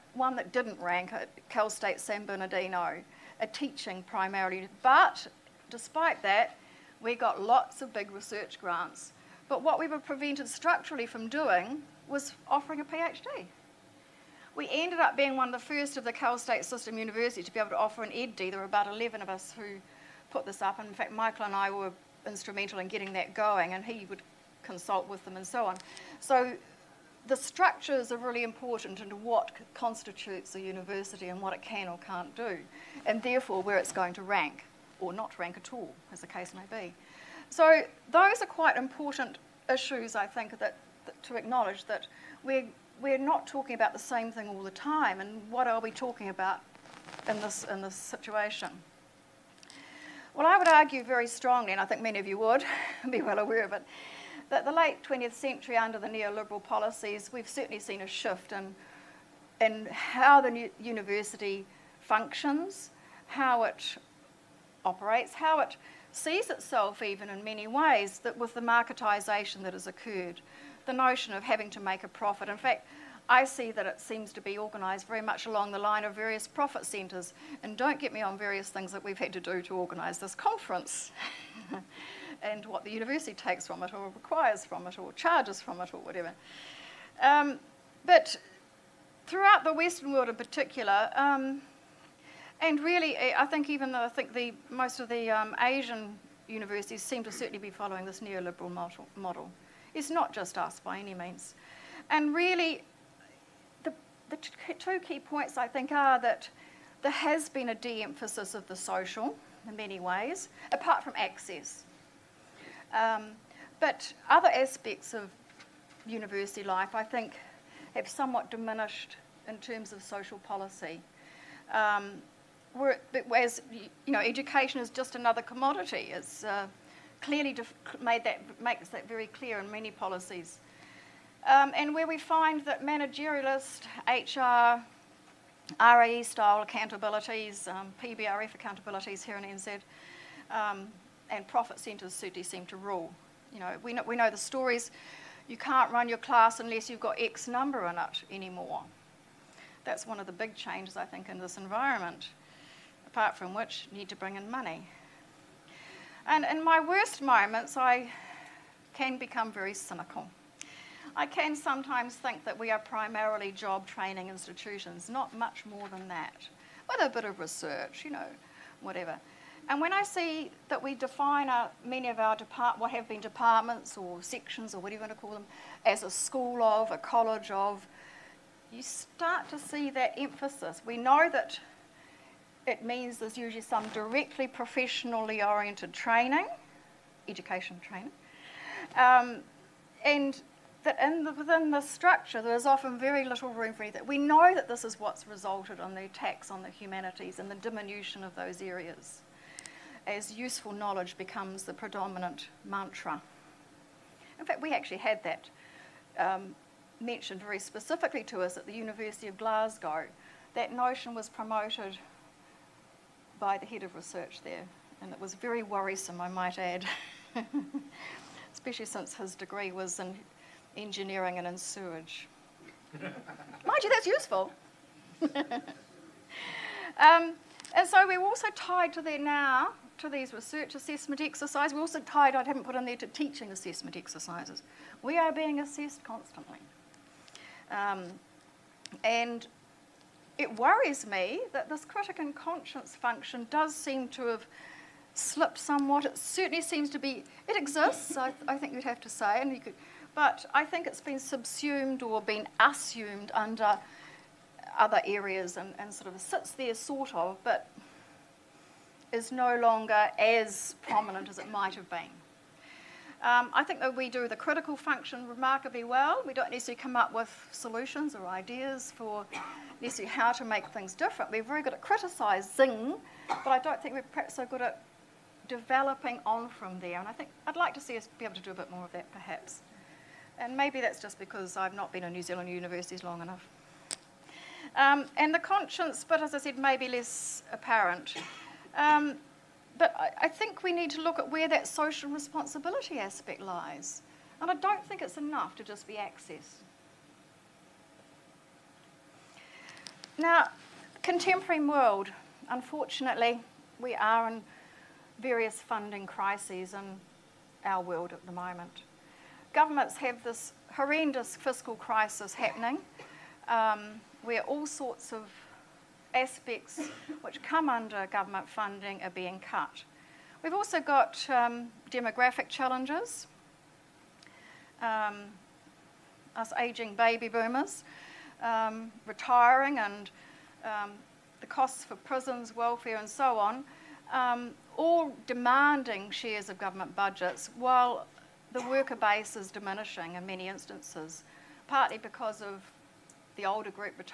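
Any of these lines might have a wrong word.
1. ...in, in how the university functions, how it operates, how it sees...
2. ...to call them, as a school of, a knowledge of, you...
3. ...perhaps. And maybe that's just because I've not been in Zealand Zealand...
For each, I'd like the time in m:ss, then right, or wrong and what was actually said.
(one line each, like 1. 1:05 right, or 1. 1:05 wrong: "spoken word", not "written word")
1. 0:58 right
2. 2:55 wrong: "college", not "knowledge"
3. 4:39 wrong: "New", not "Zealand".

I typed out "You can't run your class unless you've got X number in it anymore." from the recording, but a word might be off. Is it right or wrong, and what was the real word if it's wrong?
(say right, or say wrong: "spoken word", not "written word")
right.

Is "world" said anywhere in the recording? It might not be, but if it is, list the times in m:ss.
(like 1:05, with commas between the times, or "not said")
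1:30, 5:01, 5:07.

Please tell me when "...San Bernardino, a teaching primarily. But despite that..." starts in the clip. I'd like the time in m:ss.
0:01.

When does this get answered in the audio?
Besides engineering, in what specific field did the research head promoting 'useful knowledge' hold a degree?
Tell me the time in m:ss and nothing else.
3:41.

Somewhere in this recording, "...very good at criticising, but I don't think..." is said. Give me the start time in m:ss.
4:31.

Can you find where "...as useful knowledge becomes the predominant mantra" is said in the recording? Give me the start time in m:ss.
3:20.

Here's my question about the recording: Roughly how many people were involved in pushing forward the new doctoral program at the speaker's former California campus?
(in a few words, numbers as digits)
11.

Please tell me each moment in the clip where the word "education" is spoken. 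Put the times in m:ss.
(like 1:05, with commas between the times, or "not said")
2:04, 3:07.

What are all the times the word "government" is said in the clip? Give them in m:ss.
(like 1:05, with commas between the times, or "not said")
5:09, 5:18, 5:36.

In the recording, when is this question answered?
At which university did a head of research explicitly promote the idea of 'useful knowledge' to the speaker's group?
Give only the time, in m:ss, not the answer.
3:28.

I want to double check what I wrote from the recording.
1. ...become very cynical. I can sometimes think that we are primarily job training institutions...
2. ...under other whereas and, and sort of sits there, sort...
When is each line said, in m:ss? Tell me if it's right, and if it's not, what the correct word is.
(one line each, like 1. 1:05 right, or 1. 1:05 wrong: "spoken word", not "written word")
1. 2:39 right
2. 4:13 wrong: "areas", not "whereas".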